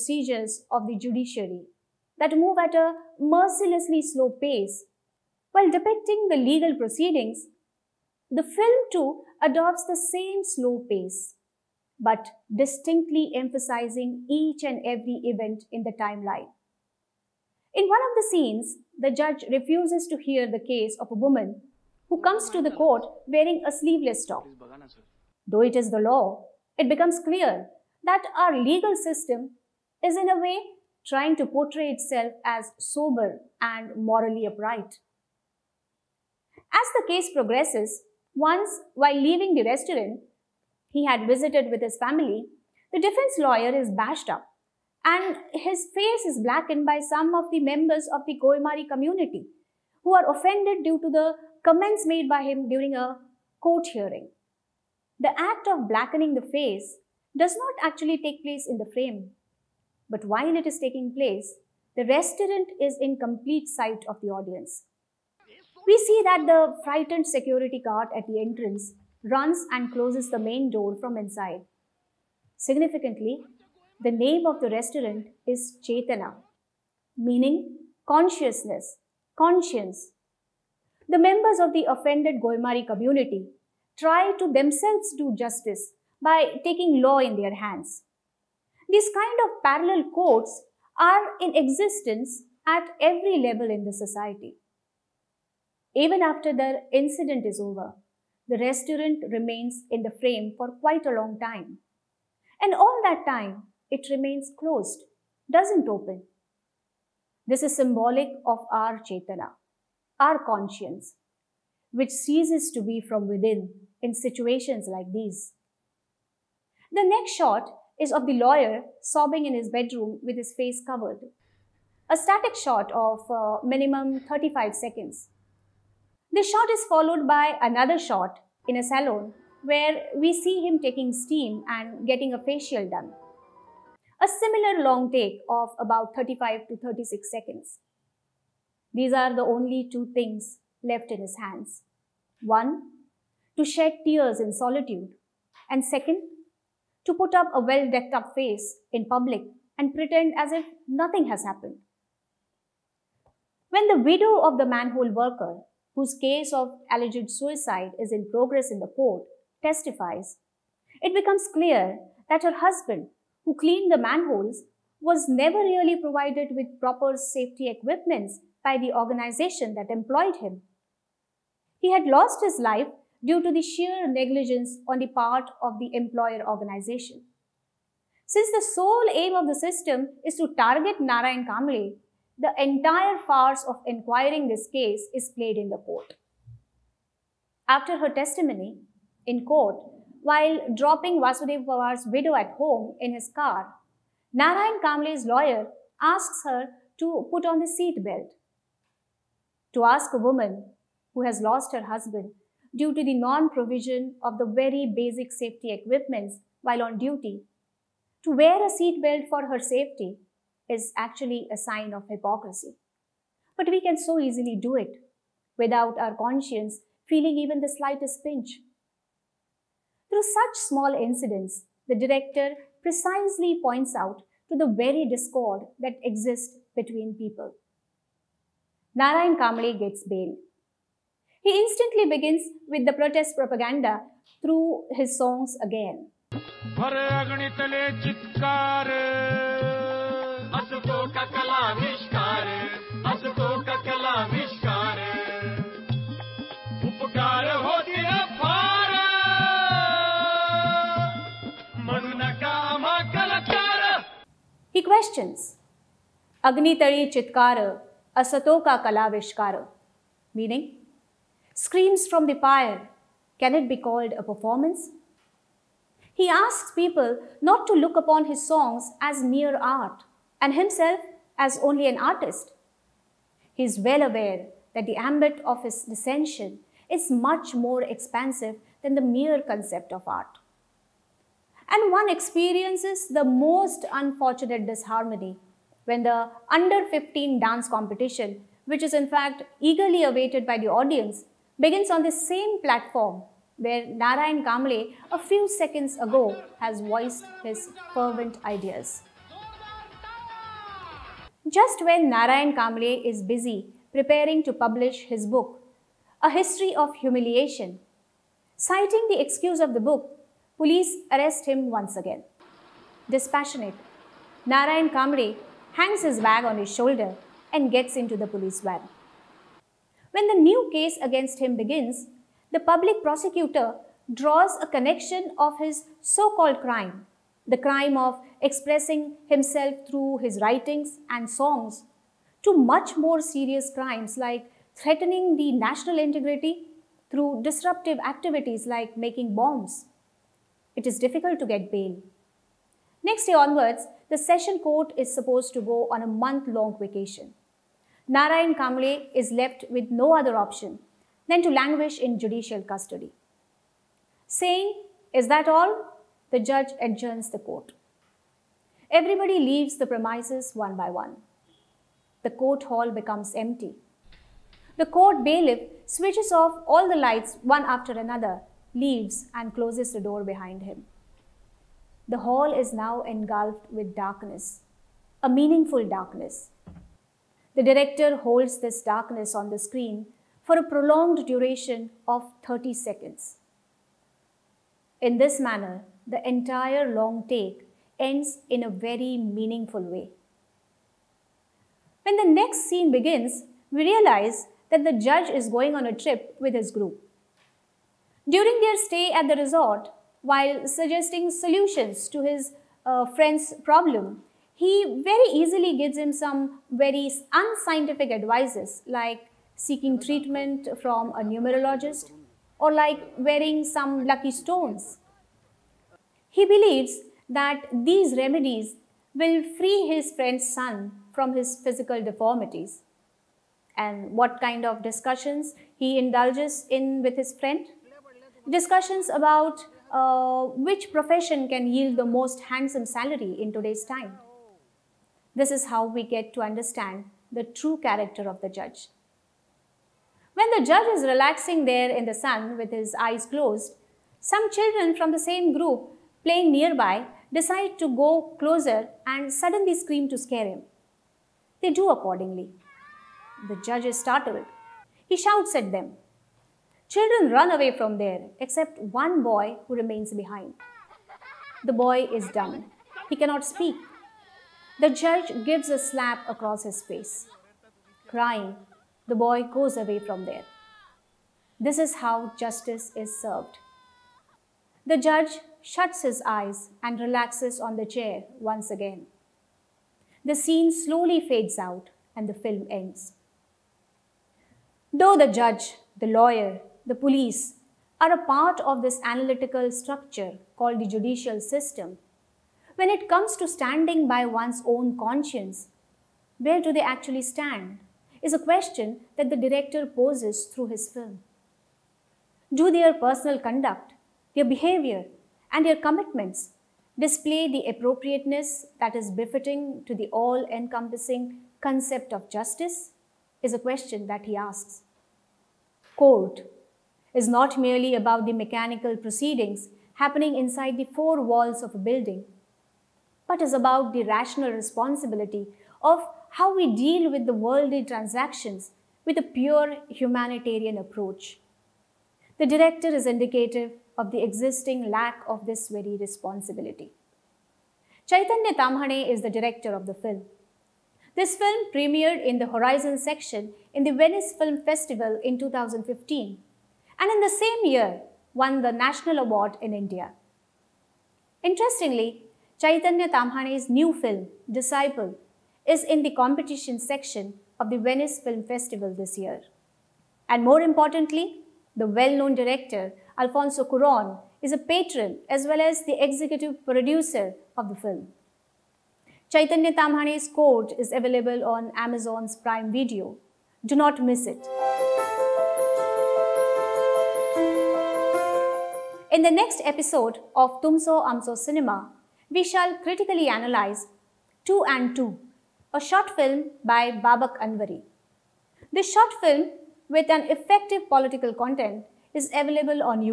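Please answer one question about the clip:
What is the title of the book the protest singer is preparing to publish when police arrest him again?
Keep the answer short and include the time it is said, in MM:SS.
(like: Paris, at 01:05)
A History of Humiliation, at 05:06.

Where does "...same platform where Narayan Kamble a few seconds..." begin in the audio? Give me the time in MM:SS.
04:52.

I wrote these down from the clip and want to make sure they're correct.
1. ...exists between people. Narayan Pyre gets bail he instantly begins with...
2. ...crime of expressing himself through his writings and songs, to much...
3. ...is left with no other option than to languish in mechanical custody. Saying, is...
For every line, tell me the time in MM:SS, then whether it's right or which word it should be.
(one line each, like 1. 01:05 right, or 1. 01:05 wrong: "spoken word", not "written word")
1. 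03:46 wrong: "Kamble", not "Pyre"
2. 05:27 right
3. 05:49 wrong: "judicial", not "mechanical".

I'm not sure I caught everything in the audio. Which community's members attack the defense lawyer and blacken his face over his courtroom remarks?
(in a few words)
Goemari.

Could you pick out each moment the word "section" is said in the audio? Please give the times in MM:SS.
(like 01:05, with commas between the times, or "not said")
09:02, 09:16.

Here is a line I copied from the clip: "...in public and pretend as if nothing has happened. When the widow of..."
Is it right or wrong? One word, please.
right.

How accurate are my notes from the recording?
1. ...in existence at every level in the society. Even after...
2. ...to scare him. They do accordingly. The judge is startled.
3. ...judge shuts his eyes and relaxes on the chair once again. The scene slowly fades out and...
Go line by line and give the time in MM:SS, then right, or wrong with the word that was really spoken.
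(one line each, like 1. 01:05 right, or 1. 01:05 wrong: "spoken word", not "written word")
1. 01:31 right
2. 07:30 right
3. 07:54 right.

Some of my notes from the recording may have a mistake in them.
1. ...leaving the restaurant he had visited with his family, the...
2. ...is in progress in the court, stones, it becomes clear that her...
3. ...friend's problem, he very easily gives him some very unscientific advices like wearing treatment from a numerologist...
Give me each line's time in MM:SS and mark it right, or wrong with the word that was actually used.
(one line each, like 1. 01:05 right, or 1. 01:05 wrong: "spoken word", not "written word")
1. 00:39 right
2. 02:38 wrong: "testifies", not "stones"
3. 06:43 wrong: "seeking", not "wearing".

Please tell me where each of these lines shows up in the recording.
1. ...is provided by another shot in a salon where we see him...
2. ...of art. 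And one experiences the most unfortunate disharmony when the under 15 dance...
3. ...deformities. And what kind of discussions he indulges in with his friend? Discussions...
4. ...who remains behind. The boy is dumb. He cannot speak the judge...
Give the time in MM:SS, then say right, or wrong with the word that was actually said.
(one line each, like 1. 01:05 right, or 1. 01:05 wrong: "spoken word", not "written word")
1. 02:06 wrong: "followed", not "provided"
2. 04:39 right
3. 07:02 right
4. 07:39 right.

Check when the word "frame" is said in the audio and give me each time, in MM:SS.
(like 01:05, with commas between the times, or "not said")
00:58, 01:40.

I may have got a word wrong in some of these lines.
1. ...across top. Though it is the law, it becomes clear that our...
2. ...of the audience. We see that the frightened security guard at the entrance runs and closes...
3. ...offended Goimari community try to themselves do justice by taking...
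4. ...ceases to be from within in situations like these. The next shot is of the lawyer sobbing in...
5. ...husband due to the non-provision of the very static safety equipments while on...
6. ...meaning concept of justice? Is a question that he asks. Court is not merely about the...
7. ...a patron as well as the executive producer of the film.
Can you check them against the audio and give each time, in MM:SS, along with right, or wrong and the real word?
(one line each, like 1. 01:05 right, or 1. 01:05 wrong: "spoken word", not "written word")
1. 00:23 wrong: "sleeveless", not "across"
2. 01:04 right
3. 01:21 right
4. 01:52 right
5. 03:21 wrong: "basic", not "static"
6. 08:30 wrong: "encompassing", not "meaning"
7. 09:24 right.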